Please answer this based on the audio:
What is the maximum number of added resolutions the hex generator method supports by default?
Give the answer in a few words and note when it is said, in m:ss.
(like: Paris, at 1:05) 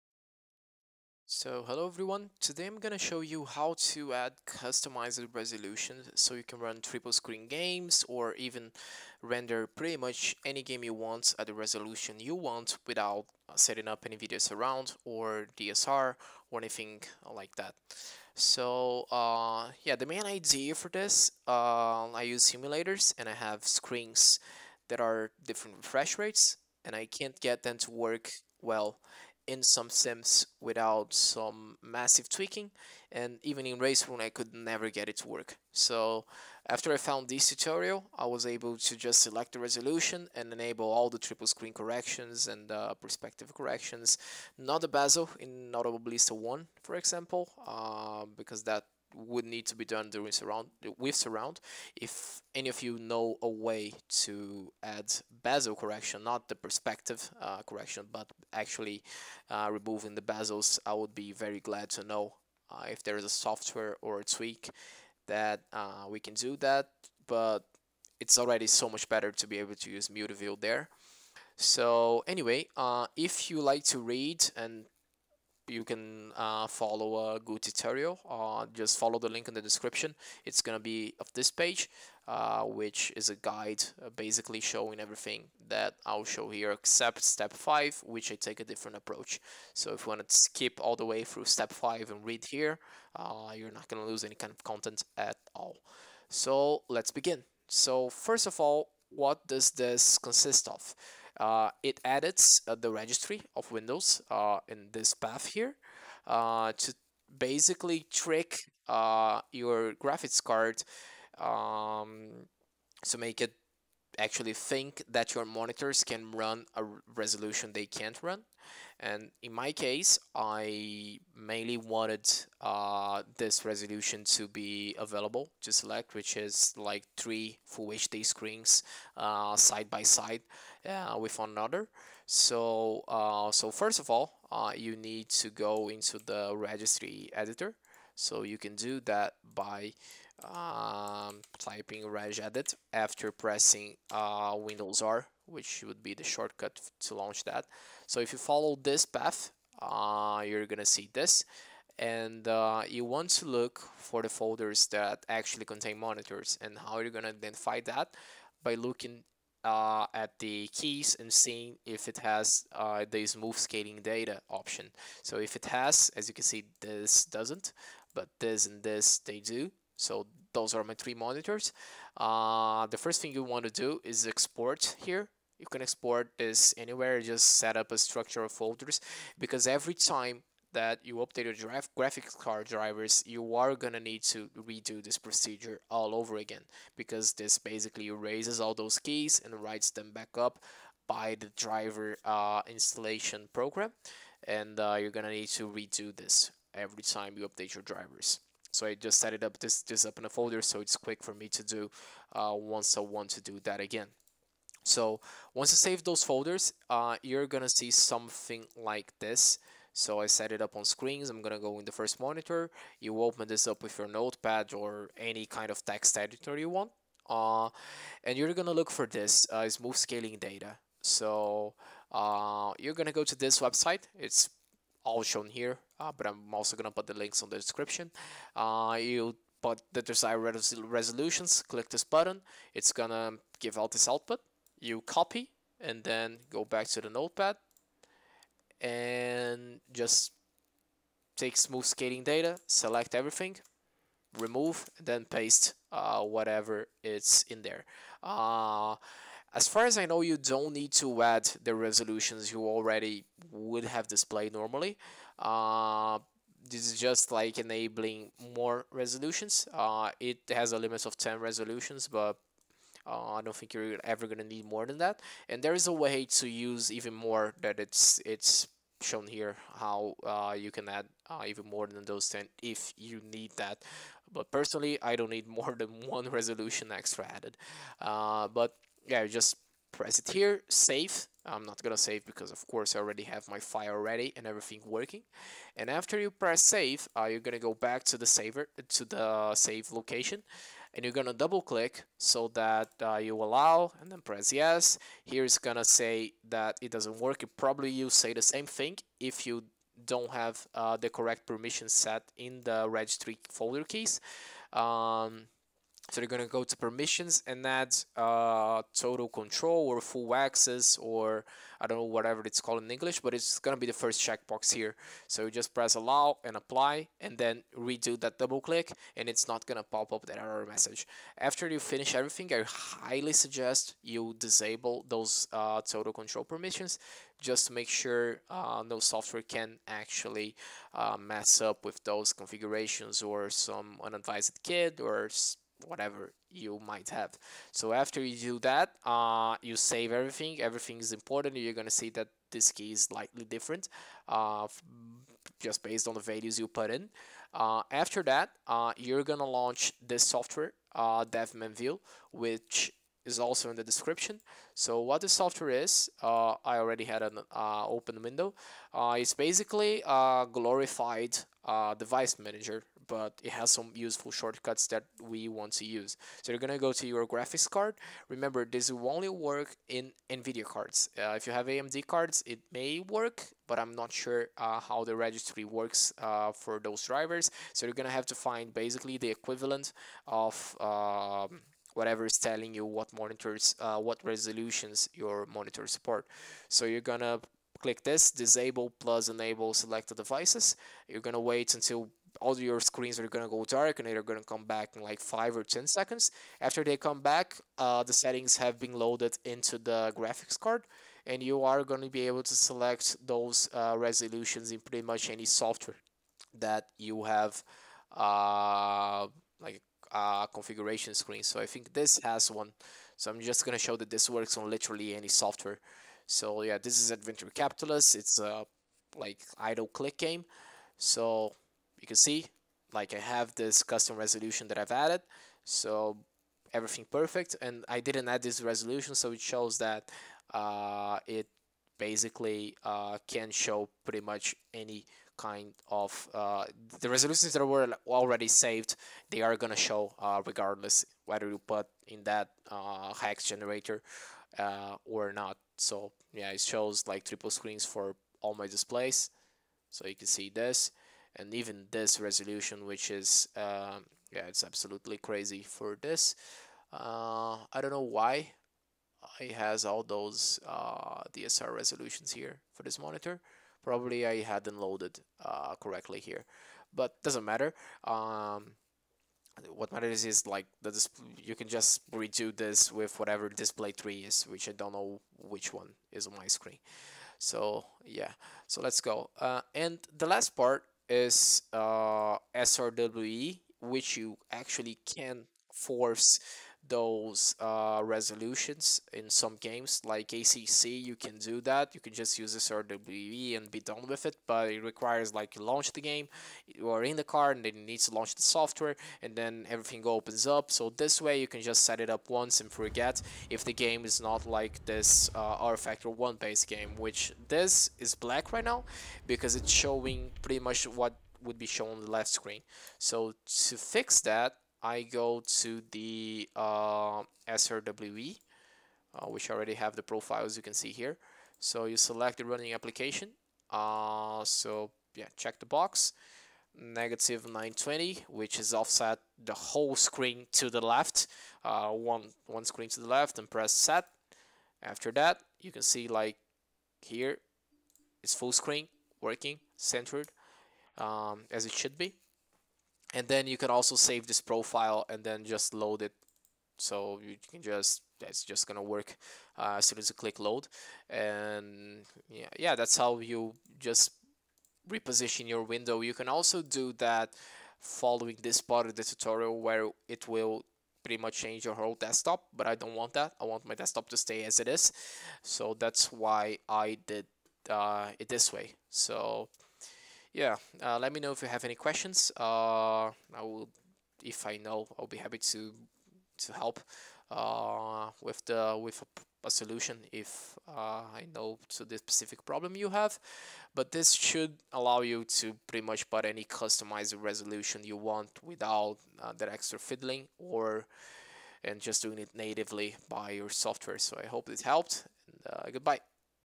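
10, at 4:21.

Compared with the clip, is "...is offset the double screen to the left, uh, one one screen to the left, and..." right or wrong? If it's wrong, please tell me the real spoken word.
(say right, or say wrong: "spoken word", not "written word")
wrong: "whole", not "double".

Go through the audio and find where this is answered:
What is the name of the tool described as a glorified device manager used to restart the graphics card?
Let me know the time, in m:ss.
5:51.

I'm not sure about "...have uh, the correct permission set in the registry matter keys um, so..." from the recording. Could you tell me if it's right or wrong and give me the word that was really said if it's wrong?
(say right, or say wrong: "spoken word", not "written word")
wrong: "folder", not "matter".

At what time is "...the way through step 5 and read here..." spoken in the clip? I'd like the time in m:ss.
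1:30.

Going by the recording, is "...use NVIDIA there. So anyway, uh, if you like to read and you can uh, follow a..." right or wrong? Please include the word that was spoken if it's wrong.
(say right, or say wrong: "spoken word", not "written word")
wrong: "MutaView", not "NVIDIA".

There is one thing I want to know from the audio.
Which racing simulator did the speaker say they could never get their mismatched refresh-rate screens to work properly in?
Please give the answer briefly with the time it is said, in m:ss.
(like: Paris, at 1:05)
Race Room, at 0:33.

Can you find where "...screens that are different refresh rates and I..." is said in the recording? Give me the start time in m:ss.
0:23.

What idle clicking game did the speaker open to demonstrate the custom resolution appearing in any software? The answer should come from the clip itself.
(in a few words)
Adventure Capitalist.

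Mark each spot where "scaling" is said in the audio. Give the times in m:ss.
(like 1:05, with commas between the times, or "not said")
2:43, 3:39, 4:01.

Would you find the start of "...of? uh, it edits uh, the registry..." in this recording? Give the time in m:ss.
1:40.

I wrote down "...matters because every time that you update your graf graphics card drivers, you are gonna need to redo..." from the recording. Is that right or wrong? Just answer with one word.
wrong.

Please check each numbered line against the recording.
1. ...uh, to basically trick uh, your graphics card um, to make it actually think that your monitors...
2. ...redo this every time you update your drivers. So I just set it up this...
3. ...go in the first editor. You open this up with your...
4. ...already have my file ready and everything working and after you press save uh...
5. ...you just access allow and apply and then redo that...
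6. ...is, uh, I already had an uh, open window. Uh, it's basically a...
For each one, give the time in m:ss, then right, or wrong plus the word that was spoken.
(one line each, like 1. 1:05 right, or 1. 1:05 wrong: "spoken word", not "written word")
1. 1:46 right
2. 3:15 right
3. 3:31 wrong: "monitor", not "editor"
4. 4:42 right
5. 5:15 wrong: "press", not "access"
6. 5:55 right.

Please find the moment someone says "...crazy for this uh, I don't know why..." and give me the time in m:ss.
7:35.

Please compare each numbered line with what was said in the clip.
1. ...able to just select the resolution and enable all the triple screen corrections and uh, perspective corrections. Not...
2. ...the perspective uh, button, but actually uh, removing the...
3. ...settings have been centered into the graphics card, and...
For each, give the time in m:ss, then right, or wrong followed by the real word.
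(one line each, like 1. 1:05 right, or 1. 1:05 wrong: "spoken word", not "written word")
1. 0:38 right
2. 0:56 wrong: "correction", not "button"
3. 6:38 wrong: "loaded", not "centered".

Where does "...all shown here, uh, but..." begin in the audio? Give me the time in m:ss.
3:45.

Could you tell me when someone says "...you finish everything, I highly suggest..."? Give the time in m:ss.
5:21.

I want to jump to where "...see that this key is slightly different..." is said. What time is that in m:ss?
5:41.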